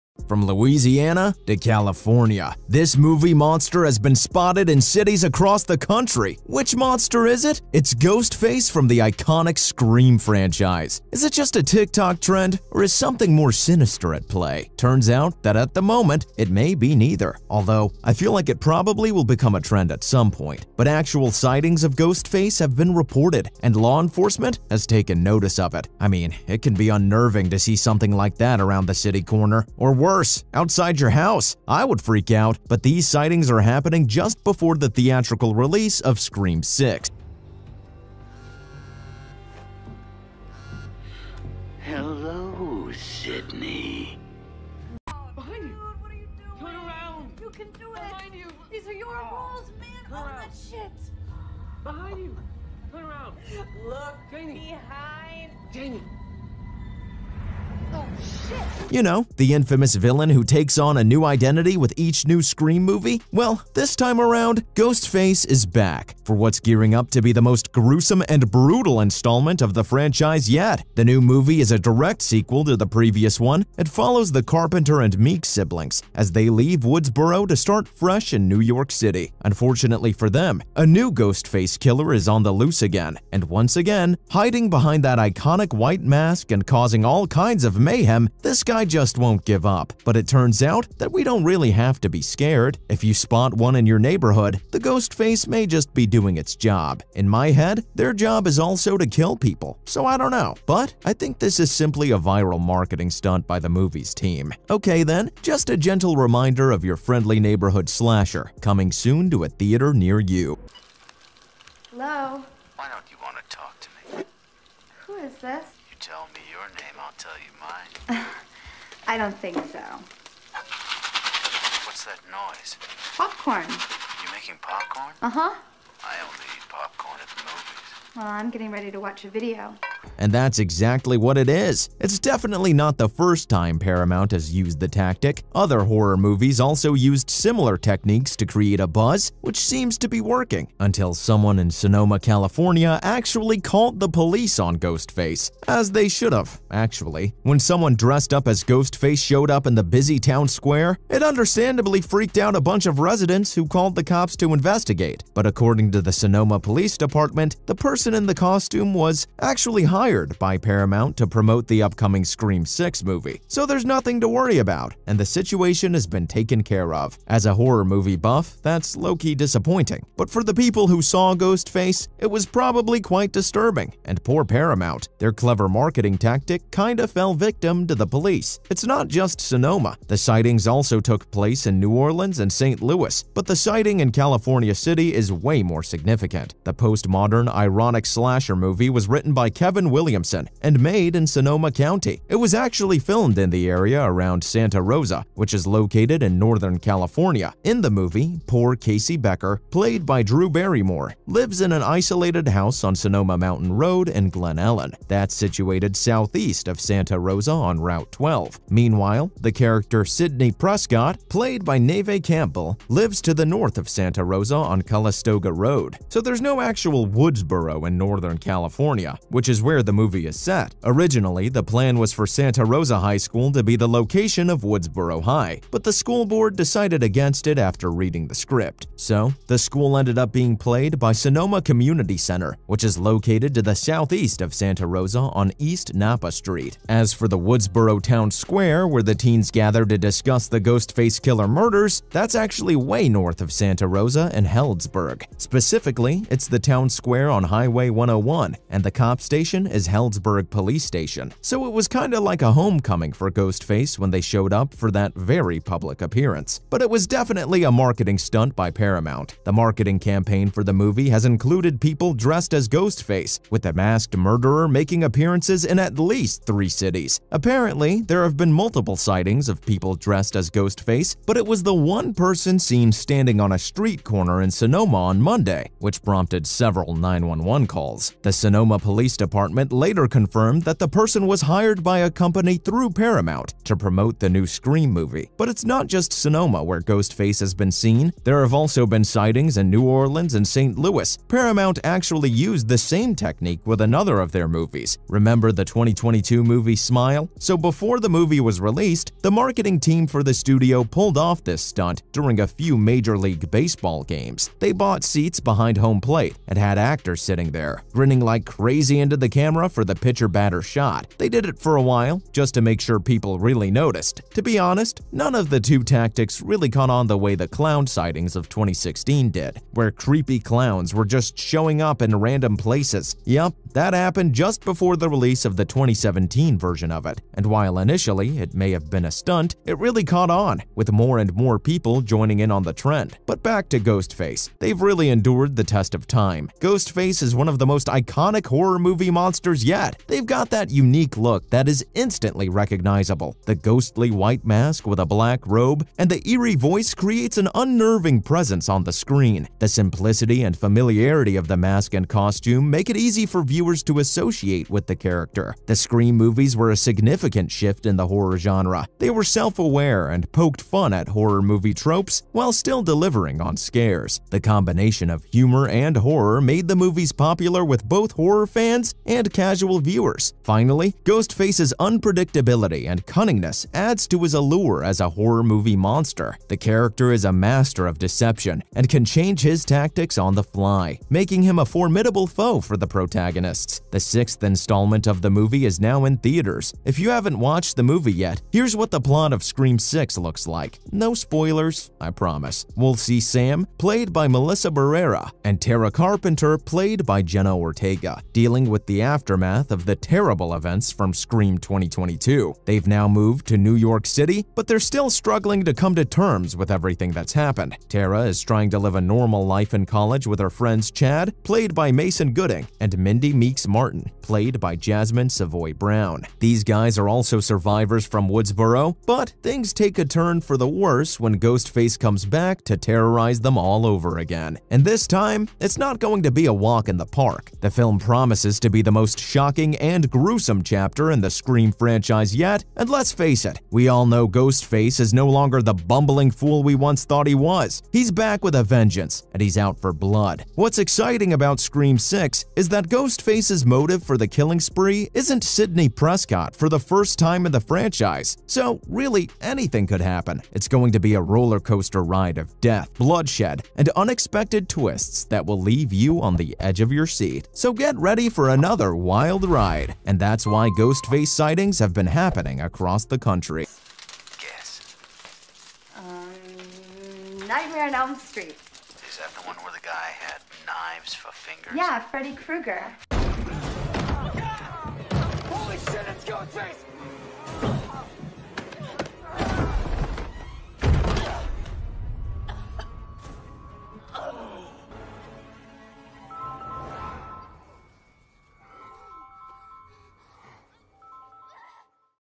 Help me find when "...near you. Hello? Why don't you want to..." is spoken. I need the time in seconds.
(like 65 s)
109 s.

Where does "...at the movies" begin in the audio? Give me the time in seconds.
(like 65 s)
127 s.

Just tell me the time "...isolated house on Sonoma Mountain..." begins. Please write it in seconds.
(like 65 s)
201 s.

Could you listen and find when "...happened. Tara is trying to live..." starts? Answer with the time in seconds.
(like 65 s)
407 s.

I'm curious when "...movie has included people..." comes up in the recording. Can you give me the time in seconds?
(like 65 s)
260 s.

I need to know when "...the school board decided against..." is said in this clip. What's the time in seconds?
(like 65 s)
225 s.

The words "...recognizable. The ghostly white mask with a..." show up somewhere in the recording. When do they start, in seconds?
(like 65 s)
342 s.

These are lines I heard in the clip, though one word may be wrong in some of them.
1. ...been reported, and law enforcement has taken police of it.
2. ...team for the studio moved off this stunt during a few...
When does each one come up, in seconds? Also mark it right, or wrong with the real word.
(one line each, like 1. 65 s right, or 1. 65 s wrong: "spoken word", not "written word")
1. 22 s wrong: "notice", not "police"
2. 299 s wrong: "pulled", not "moved".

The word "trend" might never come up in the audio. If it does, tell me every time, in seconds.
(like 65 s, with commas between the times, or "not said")
12 s, 19 s, 332 s.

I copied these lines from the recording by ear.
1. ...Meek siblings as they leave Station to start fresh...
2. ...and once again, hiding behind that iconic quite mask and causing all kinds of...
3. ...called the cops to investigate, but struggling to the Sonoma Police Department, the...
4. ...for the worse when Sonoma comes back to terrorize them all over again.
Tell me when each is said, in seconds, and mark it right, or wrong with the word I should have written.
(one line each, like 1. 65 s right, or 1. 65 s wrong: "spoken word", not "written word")
1. 75 s wrong: "Woodsboro", not "Station"
2. 83 s wrong: "white", not "quite"
3. 153 s wrong: "according", not "struggling"
4. 420 s wrong: "Ghostface", not "Sonoma".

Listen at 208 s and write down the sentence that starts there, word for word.
Meanwhile, the character Sidney Prescott, played by Neve Campbell, lives to the north of Santa Rosa on Calistoga Road.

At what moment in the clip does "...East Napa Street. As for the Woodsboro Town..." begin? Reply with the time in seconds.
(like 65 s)
235 s.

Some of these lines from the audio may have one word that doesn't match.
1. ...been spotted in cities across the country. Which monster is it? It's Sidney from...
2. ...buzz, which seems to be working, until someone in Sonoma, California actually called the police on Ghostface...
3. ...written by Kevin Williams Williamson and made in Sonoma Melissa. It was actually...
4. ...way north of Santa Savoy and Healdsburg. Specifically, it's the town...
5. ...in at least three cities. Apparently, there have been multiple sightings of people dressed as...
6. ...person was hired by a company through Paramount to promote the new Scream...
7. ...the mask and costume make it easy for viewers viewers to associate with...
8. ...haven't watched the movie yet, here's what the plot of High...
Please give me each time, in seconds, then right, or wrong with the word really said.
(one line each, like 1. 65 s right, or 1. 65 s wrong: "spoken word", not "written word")
1. 3 s wrong: "Ghostface", not "Sidney"
2. 138 s right
3. 189 s wrong: "County", not "Melissa"
4. 242 s wrong: "Rosa", not "Savoy"
5. 265 s right
6. 280 s right
7. 351 s right
8. 387 s wrong: "Scream", not "High".